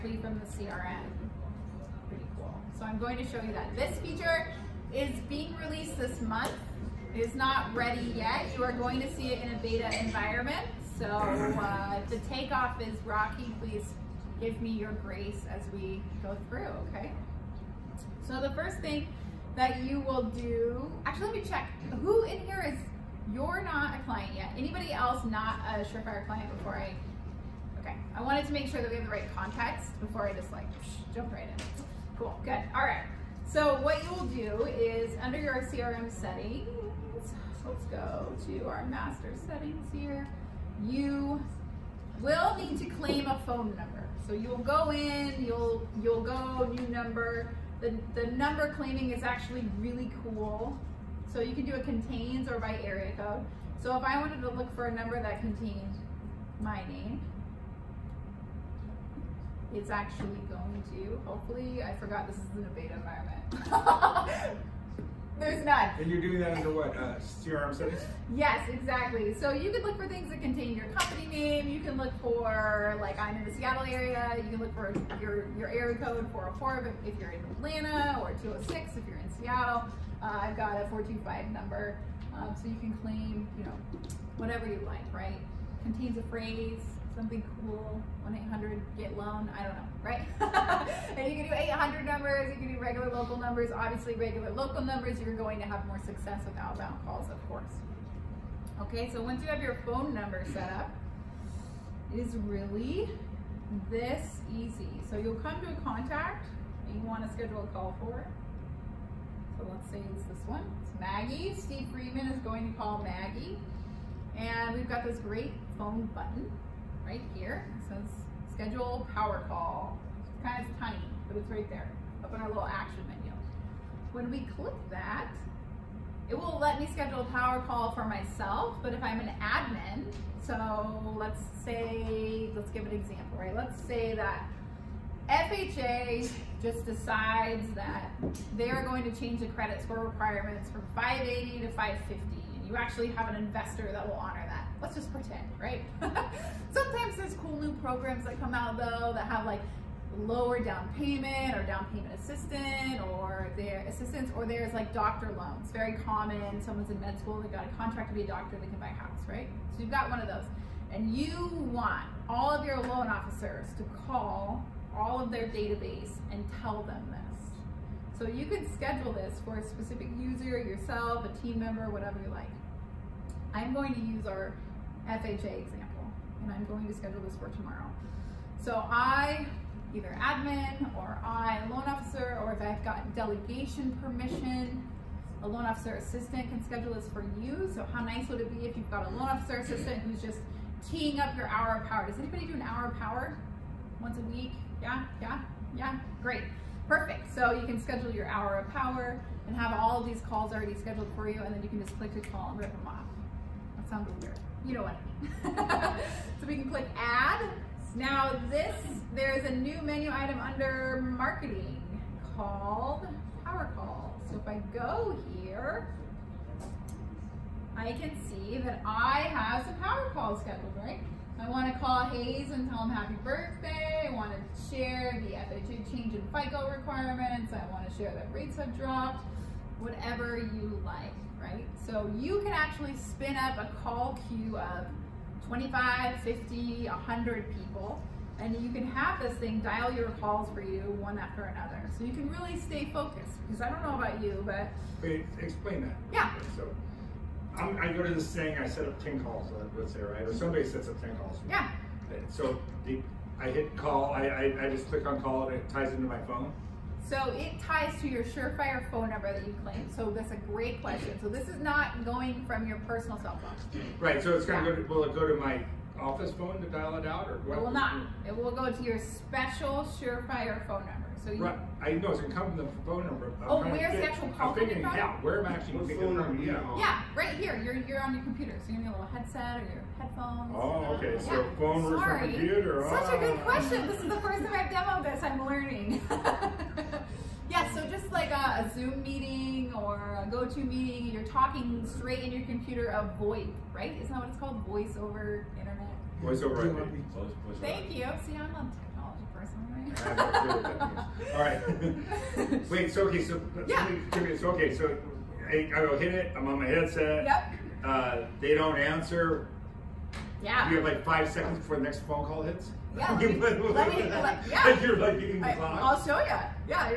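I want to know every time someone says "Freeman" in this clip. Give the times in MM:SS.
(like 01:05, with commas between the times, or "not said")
01:51.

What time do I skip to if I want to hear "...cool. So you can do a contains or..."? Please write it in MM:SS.
00:50.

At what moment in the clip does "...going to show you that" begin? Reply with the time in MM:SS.
00:02.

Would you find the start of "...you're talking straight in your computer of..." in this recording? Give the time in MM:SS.
04:51.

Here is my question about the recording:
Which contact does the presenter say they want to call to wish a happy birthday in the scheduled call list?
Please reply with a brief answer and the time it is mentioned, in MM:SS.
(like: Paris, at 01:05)
Hayes, at 03:42.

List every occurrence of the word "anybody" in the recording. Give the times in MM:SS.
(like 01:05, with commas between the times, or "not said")
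00:24, 03:12.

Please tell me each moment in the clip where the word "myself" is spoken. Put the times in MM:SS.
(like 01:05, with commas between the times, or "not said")
02:08.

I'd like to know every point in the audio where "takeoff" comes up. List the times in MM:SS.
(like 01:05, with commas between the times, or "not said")
00:12.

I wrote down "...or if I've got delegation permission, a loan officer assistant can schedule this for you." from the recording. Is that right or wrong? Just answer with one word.
right.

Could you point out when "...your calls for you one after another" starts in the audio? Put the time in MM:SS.
03:59.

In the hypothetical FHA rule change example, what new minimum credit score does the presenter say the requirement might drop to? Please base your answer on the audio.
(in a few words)
550.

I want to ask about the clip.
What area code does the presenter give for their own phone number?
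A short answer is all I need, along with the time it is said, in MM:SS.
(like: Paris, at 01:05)
425, at 01:20.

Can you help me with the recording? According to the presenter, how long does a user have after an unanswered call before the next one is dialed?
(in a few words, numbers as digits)
5 seconds.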